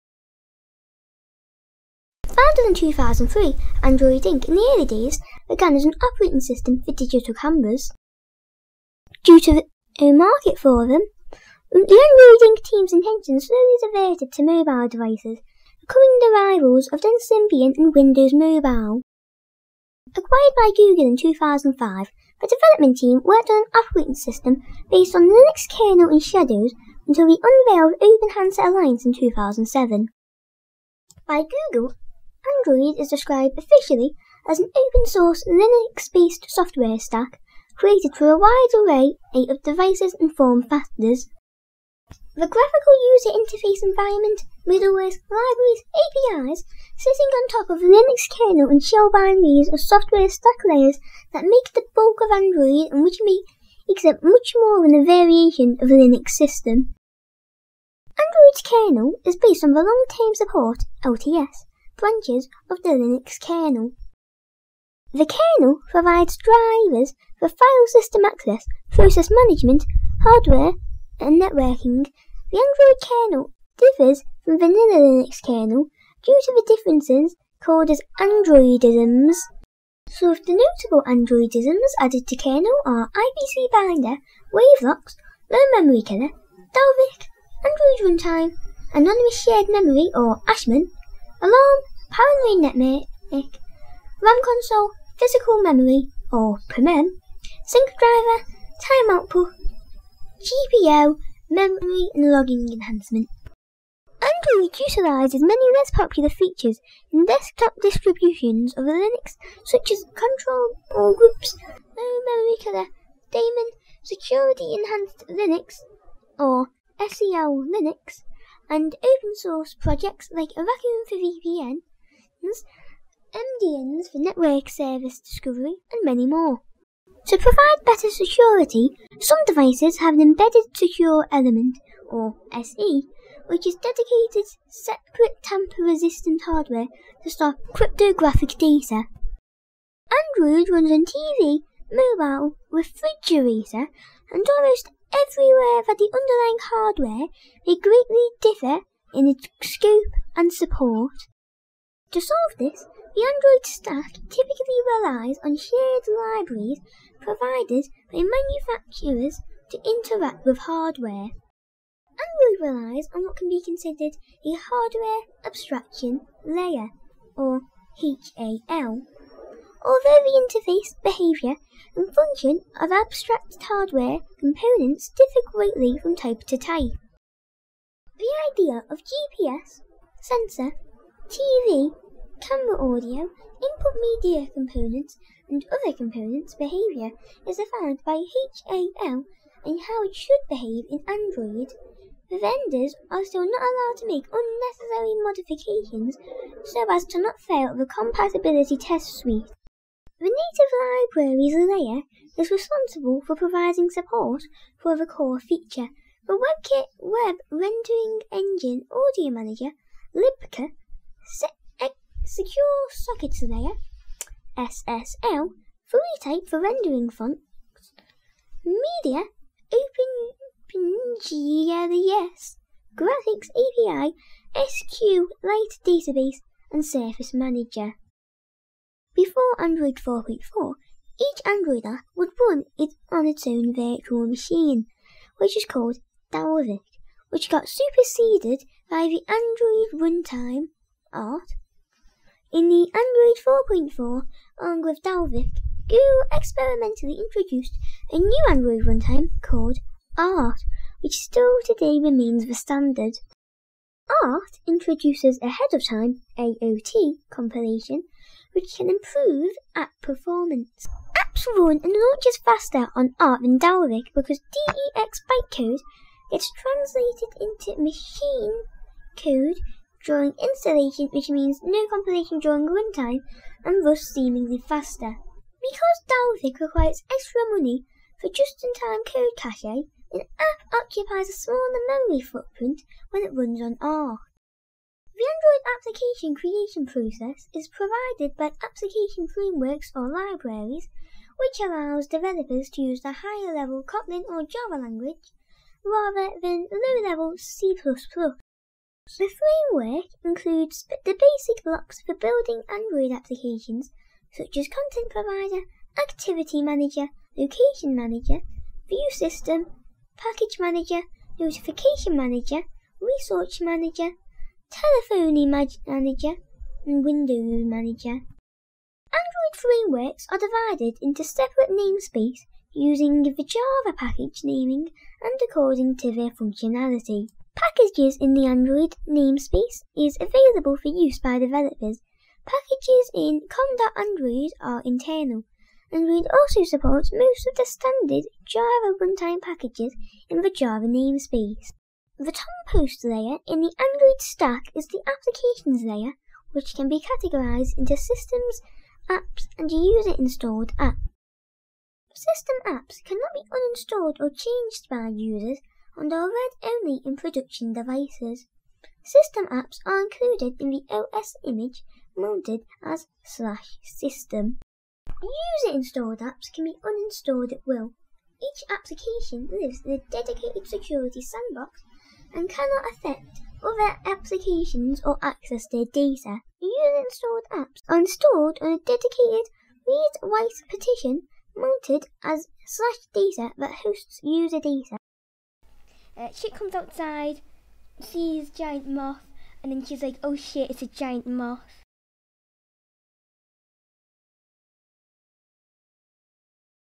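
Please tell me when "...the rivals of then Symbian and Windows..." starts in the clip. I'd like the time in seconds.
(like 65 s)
16 s.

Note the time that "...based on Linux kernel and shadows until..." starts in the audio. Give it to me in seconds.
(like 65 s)
24 s.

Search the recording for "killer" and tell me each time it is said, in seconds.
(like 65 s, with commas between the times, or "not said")
86 s, 112 s.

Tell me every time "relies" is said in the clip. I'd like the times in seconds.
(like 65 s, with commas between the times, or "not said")
154 s, 162 s.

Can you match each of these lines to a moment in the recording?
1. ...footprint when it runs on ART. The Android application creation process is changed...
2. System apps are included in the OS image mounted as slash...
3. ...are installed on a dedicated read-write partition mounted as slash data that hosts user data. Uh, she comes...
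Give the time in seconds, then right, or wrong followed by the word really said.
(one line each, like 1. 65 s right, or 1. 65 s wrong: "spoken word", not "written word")
1. 282 s wrong: "provided", not "changed"
2. 359 s right
3. 377 s right.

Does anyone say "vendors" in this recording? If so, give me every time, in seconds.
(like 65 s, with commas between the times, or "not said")
192 s.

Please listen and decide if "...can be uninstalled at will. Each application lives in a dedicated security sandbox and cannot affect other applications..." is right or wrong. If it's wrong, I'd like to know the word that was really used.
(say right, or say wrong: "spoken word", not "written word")
right.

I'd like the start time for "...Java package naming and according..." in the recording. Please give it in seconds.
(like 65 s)
323 s.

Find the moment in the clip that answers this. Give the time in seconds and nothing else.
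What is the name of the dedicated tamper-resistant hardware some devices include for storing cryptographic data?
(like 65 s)
130 s.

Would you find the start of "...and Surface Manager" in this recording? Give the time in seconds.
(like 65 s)
226 s.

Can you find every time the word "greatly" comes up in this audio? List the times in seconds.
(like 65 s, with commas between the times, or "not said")
147 s, 175 s.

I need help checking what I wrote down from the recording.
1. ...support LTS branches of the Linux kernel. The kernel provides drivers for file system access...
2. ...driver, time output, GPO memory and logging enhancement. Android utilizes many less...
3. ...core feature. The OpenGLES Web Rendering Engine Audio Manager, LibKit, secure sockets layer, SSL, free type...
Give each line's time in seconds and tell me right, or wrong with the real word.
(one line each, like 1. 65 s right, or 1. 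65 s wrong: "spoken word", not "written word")
1. 60 s right
2. 97 s right
3. 205 s wrong: "WebKit", not "OpenGLES".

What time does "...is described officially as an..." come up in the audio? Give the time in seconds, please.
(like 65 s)
32 s.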